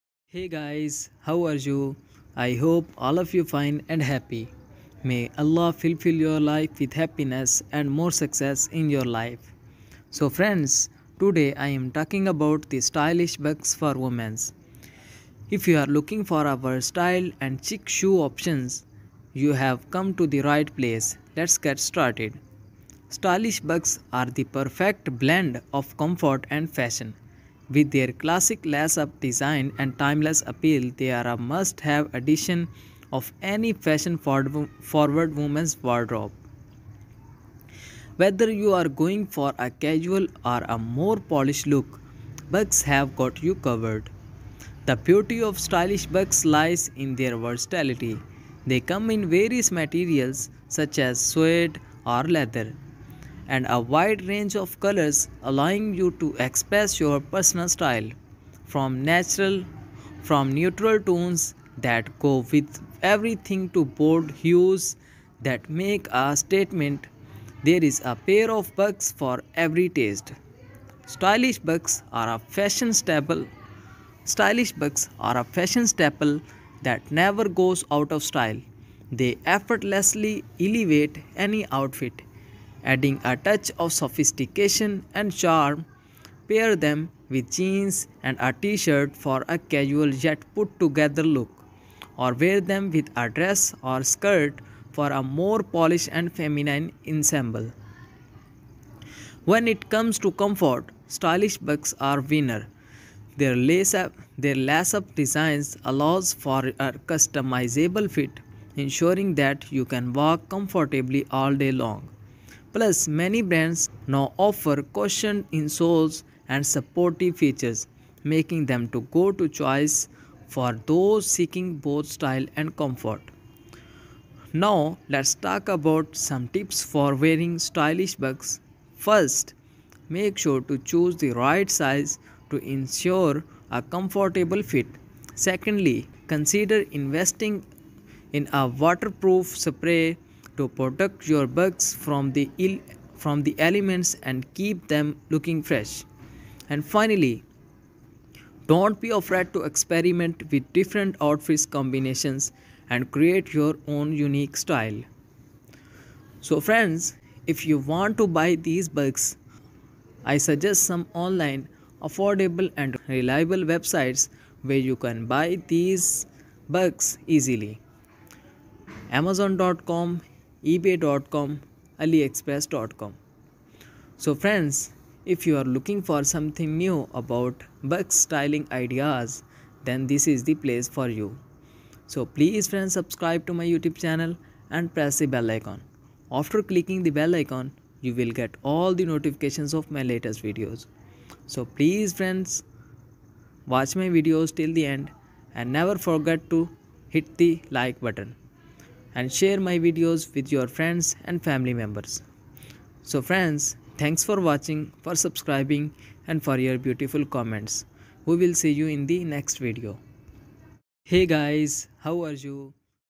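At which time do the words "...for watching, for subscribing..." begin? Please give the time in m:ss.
3:24.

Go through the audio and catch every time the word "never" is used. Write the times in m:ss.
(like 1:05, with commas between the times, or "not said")
1:17, 3:15.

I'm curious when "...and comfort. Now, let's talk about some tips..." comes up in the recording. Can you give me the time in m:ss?
2:02.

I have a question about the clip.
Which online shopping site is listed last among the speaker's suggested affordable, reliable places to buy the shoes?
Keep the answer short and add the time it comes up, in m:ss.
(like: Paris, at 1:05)
aliexpress.com, at 2:52.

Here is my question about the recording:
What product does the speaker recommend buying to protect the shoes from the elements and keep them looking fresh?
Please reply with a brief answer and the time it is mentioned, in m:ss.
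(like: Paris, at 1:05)
waterproof spray, at 2:18.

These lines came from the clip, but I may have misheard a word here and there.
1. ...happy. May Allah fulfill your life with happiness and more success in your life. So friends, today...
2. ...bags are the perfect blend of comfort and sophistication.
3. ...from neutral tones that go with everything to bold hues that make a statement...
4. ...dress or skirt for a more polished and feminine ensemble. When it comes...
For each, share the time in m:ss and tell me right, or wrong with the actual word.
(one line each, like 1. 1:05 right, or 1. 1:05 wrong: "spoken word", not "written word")
1. 0:04 right
2. 0:23 wrong: "fashion", not "sophistication"
3. 1:00 right
4. 1:33 right.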